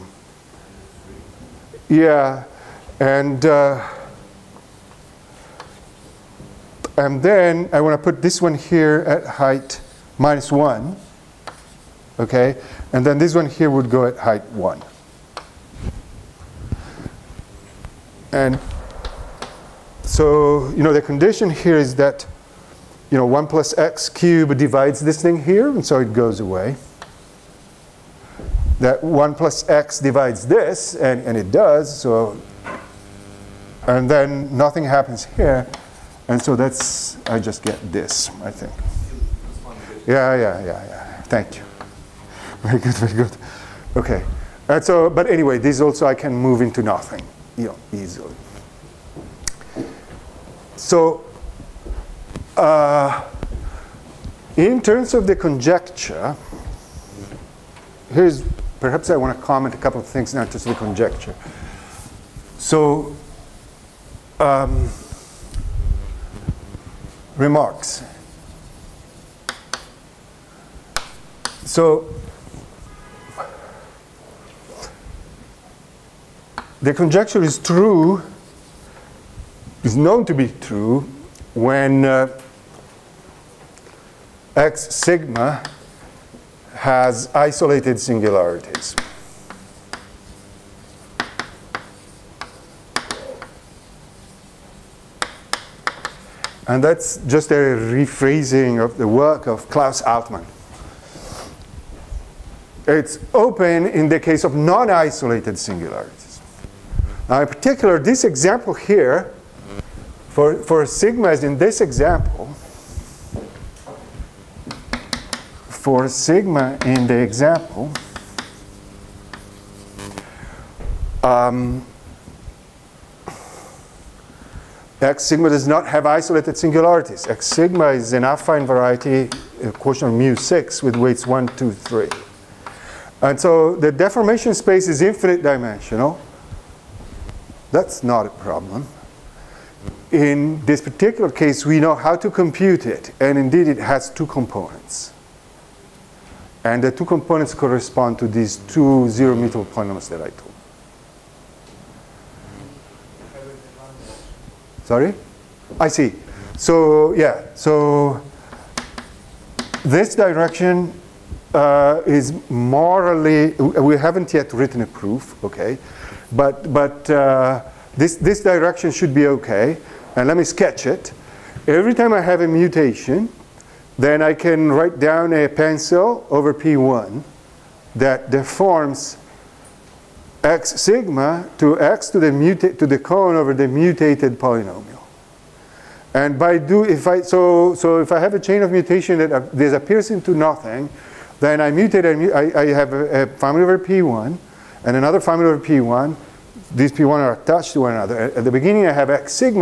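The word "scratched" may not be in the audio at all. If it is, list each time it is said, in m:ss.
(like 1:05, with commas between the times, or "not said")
not said.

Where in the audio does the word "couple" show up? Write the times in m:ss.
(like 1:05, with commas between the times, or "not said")
0:59.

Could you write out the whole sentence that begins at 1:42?
It's open in the case of non-isolated singularities.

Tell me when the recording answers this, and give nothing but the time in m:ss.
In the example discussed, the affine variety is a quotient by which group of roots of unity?
2:10.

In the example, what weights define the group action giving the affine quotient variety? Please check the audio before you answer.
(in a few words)
1, 2, 3.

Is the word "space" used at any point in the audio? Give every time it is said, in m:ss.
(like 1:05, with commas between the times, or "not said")
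2:14.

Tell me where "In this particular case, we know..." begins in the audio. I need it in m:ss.
2:20.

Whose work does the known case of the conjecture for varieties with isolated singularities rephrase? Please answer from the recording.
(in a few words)
Klaus Altmann.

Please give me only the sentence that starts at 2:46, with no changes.
But, but uh, this, this direction should be okay.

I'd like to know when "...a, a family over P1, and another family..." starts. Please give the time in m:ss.
3:12.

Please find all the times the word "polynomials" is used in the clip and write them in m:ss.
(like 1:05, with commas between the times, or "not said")
2:29, 3:04.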